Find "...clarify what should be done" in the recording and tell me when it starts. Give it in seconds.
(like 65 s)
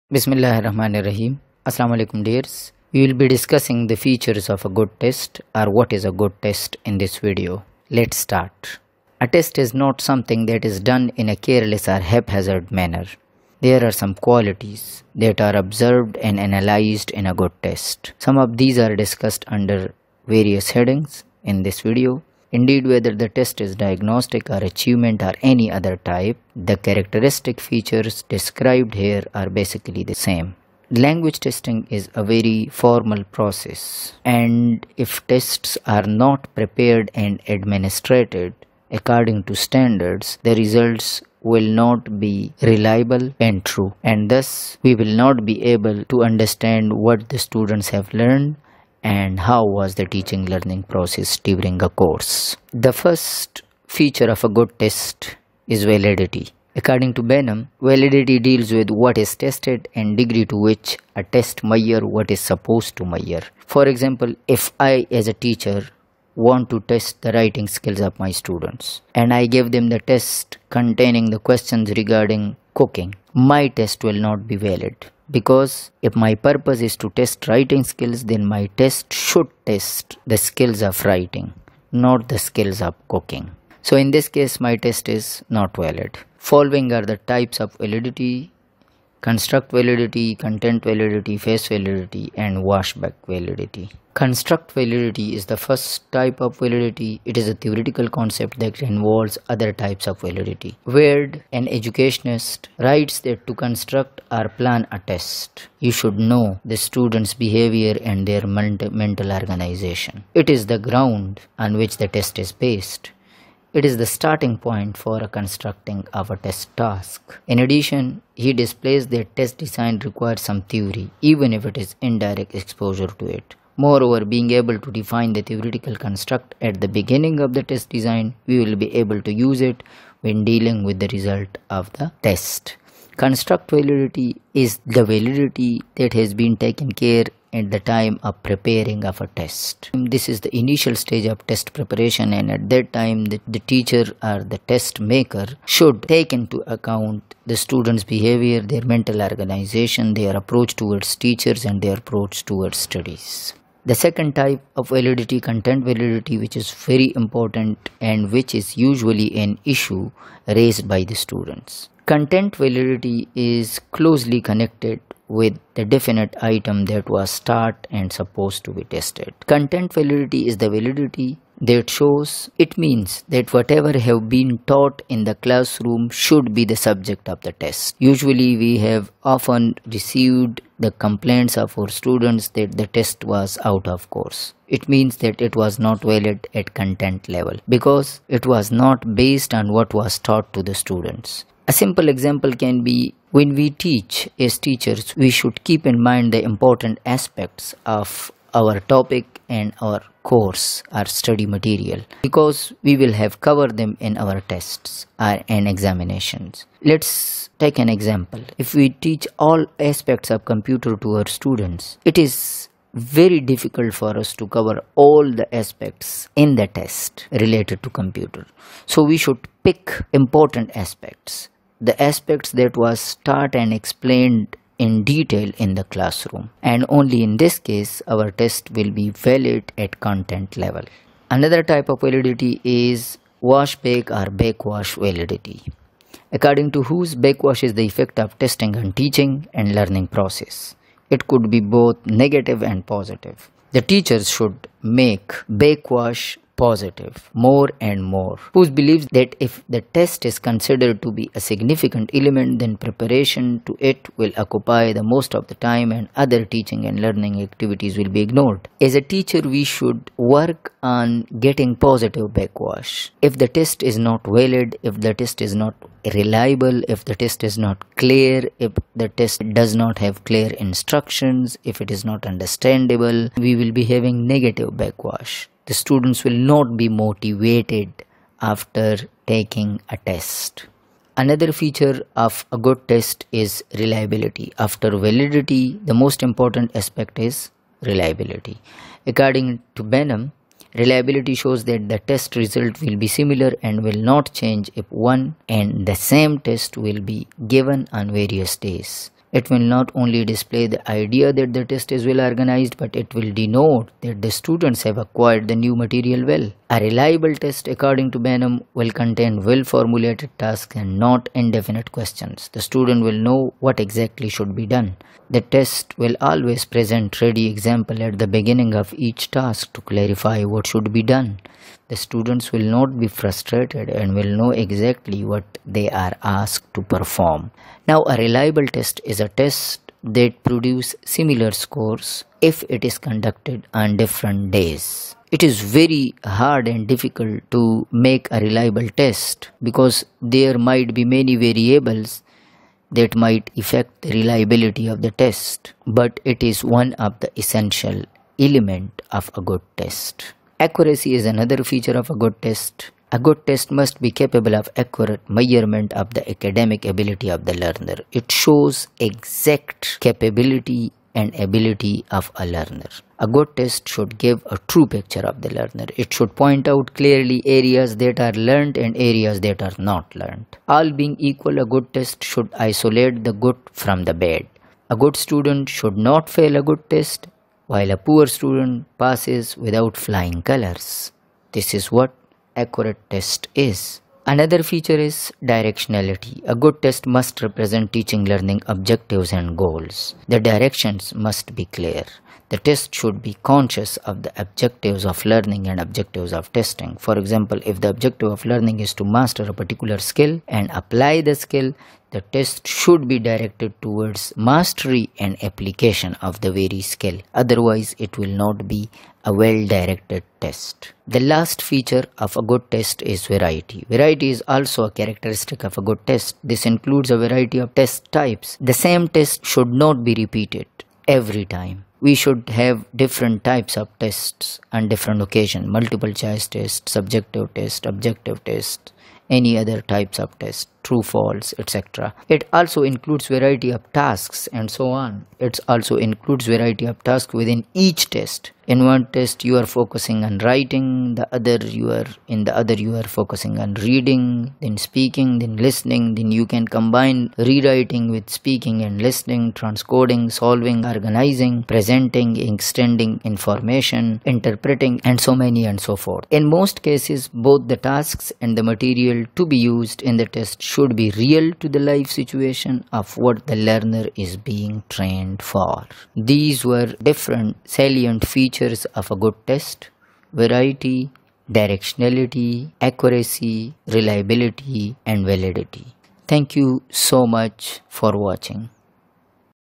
319 s.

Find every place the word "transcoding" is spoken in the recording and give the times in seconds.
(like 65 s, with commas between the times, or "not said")
449 s.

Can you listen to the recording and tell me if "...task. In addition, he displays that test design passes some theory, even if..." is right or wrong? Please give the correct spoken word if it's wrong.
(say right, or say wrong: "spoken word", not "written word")
wrong: "requires", not "passes".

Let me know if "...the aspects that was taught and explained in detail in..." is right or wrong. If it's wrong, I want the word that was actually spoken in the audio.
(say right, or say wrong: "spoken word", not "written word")
right.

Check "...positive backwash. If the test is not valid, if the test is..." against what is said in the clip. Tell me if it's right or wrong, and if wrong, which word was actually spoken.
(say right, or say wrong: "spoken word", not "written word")
right.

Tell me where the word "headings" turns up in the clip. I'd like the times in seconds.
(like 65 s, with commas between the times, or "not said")
20 s.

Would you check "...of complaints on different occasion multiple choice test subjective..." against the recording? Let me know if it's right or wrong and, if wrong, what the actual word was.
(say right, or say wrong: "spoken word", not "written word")
wrong: "tests", not "complaints".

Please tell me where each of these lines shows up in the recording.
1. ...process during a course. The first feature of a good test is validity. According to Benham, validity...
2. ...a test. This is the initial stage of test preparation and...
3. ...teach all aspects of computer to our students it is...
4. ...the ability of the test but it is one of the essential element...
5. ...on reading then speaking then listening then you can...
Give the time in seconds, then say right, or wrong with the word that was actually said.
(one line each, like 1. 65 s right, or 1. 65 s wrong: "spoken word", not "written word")
1. 50 s right
2. 139 s right
3. 209 s right
4. 344 s wrong: "reliability", not "ability"
5. 443 s right.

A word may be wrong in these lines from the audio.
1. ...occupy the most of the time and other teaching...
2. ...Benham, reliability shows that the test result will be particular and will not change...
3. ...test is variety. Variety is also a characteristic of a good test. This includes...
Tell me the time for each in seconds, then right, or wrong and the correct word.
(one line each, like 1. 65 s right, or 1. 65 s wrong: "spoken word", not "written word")
1. 254 s right
2. 289 s wrong: "similar", not "particular"
3. 412 s right.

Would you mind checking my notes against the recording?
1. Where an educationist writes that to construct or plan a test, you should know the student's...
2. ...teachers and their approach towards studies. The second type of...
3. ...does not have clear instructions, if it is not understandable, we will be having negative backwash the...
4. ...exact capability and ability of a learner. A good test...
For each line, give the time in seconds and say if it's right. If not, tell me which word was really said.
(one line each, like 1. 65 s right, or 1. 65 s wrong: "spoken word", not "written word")
1. 100 s right
2. 151 s right
3. 269 s right
4. 358 s right.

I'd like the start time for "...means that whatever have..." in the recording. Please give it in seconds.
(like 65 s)
172 s.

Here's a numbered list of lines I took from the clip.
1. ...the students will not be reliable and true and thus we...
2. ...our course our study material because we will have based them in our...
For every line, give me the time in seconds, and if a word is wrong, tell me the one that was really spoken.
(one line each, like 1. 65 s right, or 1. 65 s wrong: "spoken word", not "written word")
1. 40 s wrong: "results", not "students"
2. 199 s wrong: "covered", not "based".